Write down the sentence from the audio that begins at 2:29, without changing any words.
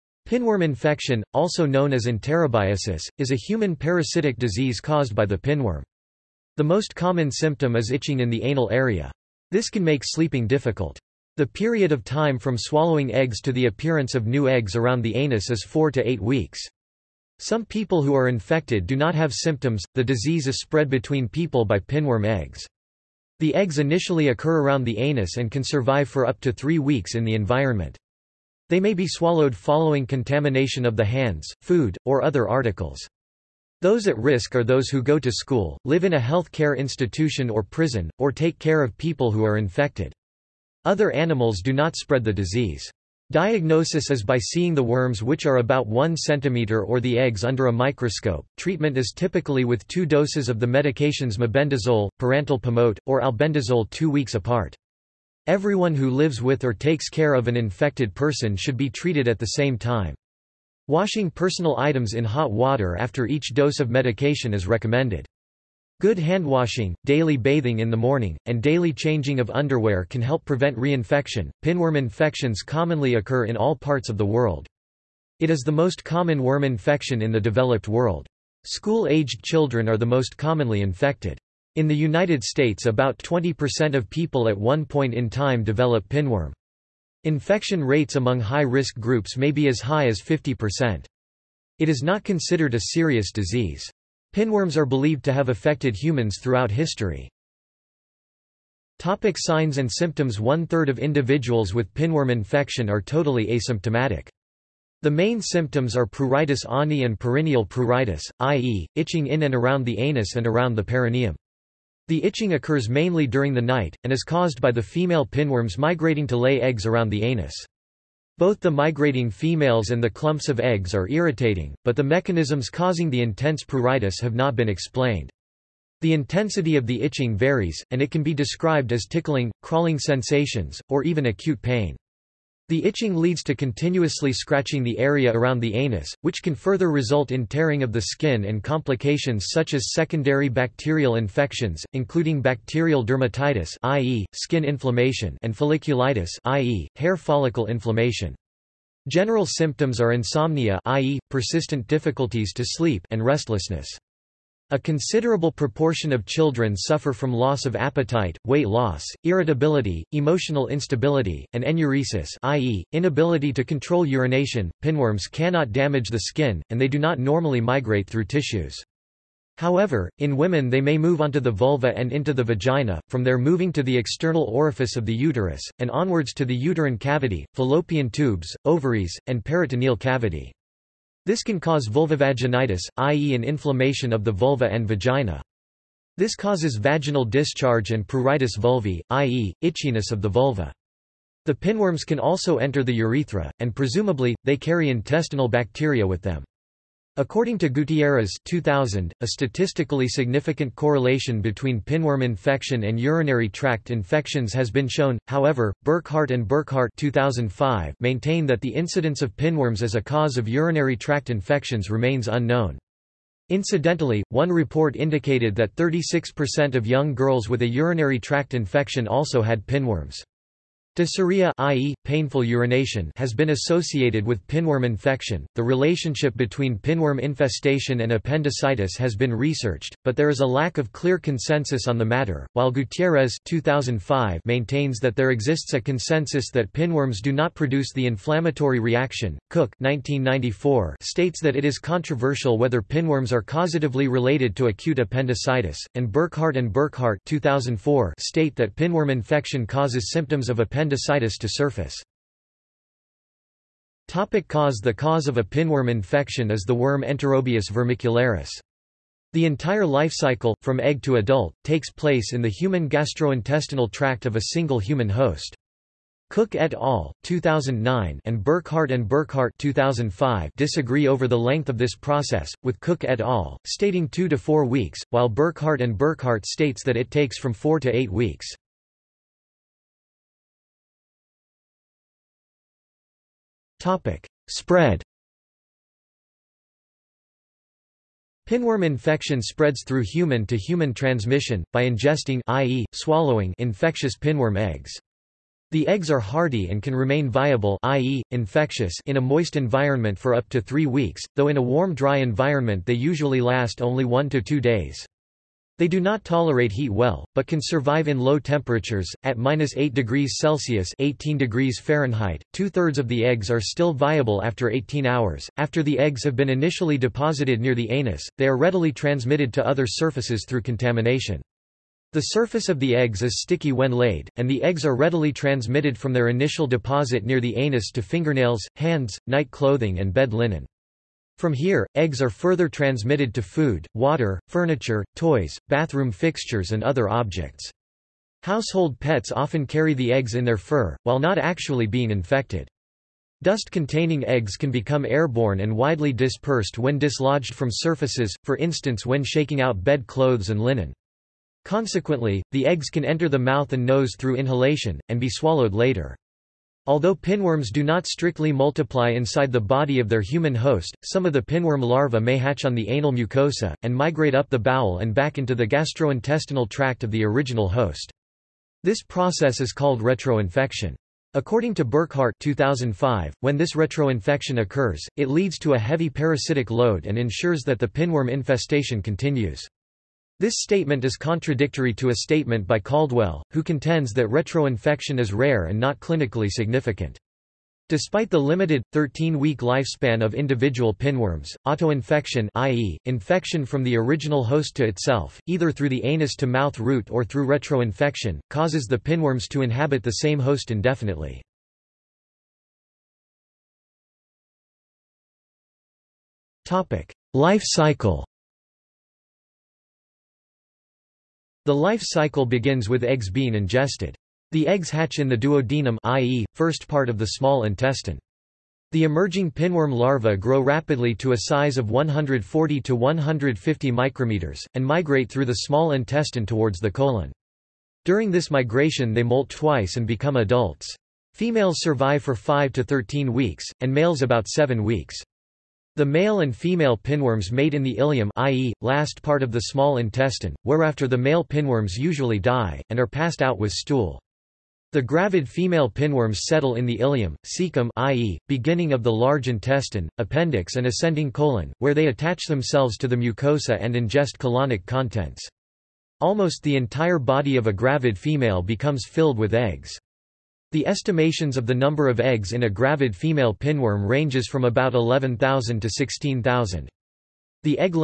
General symptoms are insomnia i.e., persistent difficulties to sleep and restlessness.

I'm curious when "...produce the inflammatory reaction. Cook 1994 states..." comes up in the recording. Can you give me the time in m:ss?
3:57.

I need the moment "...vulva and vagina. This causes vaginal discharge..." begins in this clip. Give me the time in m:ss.
3:04.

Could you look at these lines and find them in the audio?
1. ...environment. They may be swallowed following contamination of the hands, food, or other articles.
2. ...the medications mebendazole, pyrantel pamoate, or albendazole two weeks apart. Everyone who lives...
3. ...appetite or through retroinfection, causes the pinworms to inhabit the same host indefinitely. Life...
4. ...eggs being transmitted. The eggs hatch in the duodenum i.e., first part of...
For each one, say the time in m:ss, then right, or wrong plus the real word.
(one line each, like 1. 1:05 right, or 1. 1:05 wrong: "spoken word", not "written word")
1. 0:27 right
2. 0:50 right
3. 6:36 wrong: "route", not "appetite"
4. 6:53 wrong: "ingested", not "transmitted".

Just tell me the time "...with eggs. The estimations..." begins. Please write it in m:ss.
7:39.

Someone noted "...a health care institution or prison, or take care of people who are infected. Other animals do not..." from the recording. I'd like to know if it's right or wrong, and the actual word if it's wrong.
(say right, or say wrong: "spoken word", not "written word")
right.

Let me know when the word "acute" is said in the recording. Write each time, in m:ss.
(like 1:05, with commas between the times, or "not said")
2:11, 4:04.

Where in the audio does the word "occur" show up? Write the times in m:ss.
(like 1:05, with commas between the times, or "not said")
0:24, 1:13, 1:52, 6:14.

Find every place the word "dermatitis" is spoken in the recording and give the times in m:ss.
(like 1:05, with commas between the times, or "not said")
2:23.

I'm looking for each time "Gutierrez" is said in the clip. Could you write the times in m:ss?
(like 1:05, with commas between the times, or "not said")
3:17, 3:52.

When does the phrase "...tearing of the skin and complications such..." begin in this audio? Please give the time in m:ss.
2:17.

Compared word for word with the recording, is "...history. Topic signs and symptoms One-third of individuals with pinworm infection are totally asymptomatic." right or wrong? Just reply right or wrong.
right.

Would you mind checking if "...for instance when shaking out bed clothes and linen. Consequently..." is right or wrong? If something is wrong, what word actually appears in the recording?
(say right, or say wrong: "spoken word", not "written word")
right.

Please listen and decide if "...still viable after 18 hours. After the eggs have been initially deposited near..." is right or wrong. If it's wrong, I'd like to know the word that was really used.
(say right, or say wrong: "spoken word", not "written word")
right.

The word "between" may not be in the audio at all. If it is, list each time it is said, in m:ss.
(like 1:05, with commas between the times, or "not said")
0:20, 3:21, 3:46.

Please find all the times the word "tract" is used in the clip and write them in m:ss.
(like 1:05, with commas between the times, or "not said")
3:23, 3:30, 3:38, 4:23, 6:06.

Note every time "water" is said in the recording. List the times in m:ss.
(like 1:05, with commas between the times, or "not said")
1:02, 5:33.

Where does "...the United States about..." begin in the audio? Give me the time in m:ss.
1:21.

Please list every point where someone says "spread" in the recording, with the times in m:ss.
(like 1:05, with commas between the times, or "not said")
0:20, 0:41, 4:44, 4:49.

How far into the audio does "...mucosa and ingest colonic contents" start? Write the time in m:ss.
7:33.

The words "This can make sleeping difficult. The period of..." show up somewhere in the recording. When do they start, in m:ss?
0:09.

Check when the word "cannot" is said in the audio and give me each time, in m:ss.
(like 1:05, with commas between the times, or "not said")
2:45.